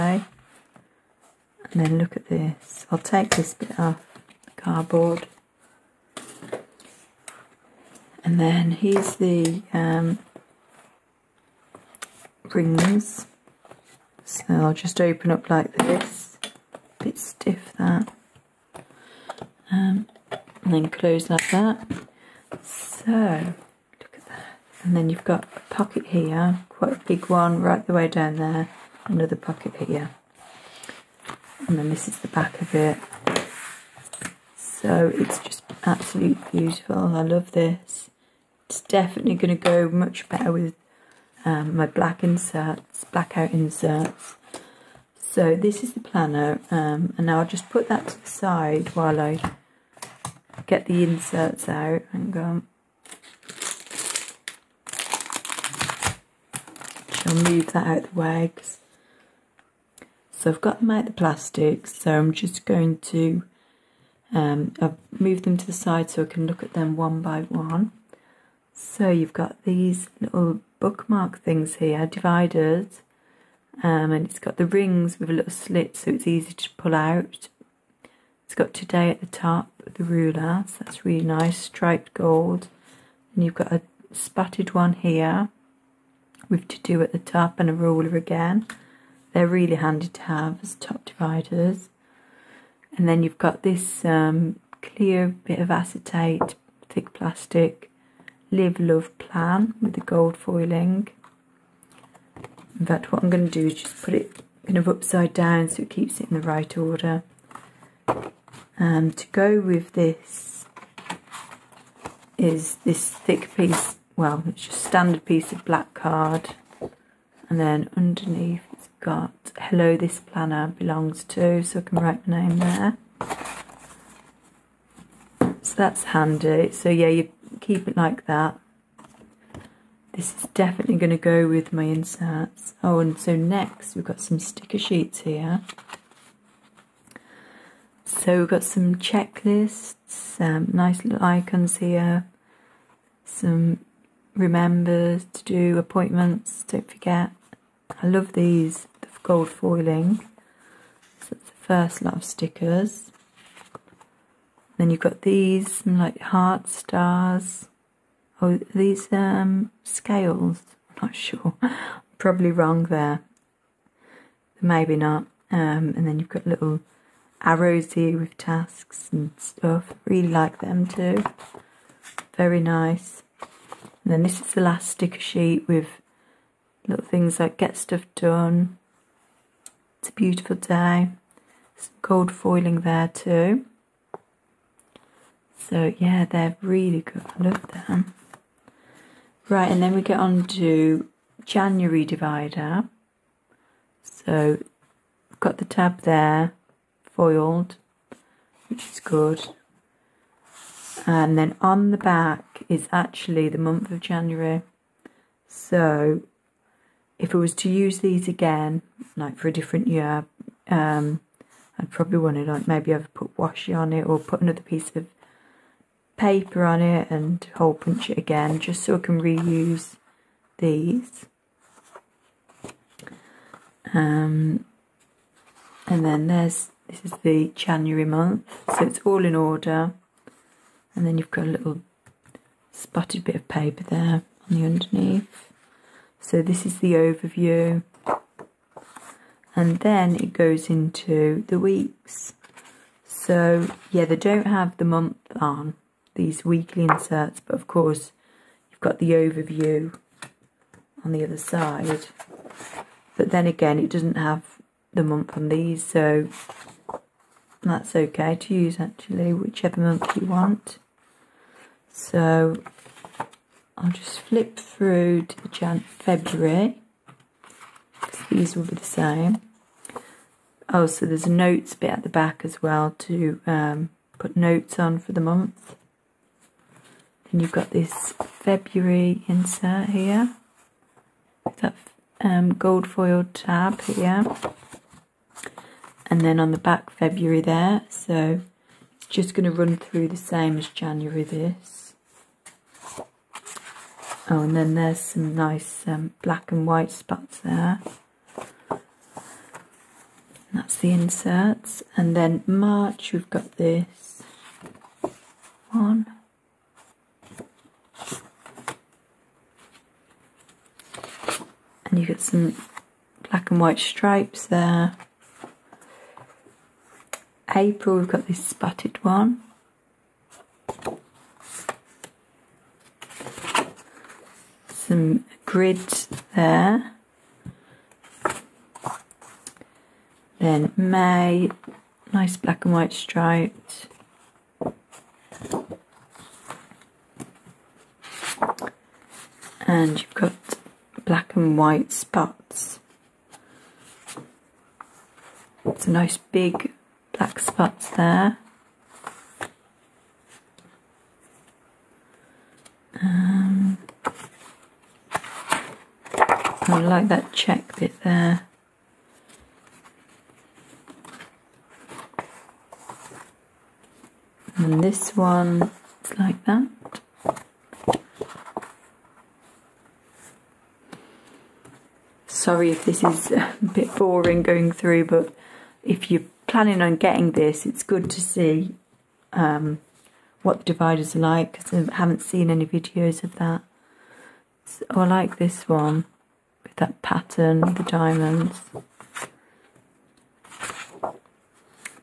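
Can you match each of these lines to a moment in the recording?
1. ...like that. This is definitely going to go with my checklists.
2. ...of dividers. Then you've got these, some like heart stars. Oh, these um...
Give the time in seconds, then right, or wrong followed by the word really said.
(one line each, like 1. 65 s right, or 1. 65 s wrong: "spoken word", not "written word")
1. 127 s wrong: "inserts", not "checklists"
2. 152 s wrong: "stickers", not "dividers".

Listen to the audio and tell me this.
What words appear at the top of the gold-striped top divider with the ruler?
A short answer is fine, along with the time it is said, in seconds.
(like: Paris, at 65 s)
today, at 78 s.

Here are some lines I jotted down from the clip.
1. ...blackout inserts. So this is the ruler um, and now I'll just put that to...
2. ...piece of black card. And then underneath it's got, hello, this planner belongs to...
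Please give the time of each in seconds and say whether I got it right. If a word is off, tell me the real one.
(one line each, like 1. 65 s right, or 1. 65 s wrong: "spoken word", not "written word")
1. 43 s wrong: "planner", not "ruler"
2. 115 s right.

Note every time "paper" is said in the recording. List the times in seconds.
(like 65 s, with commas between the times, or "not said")
216 s, 233 s, 317 s.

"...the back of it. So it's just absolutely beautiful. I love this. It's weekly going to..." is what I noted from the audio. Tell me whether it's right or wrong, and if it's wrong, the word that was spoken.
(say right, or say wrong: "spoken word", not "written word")
wrong: "definitely", not "weekly".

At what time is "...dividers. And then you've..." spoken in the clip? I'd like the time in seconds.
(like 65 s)
91 s.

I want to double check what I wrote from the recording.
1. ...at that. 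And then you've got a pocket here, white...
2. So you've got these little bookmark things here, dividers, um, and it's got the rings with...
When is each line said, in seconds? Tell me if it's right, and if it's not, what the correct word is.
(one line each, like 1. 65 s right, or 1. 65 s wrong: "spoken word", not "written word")
1. 24 s wrong: "quite", not "white"
2. 68 s right.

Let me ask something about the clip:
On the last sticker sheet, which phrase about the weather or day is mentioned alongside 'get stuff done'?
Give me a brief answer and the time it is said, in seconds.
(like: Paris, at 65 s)
It's a beautiful day, at 179 s.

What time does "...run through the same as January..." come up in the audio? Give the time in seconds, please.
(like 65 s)
289 s.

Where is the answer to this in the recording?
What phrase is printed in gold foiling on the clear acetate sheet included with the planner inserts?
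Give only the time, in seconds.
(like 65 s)
98 s.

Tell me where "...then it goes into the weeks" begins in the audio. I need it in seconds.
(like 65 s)
239 s.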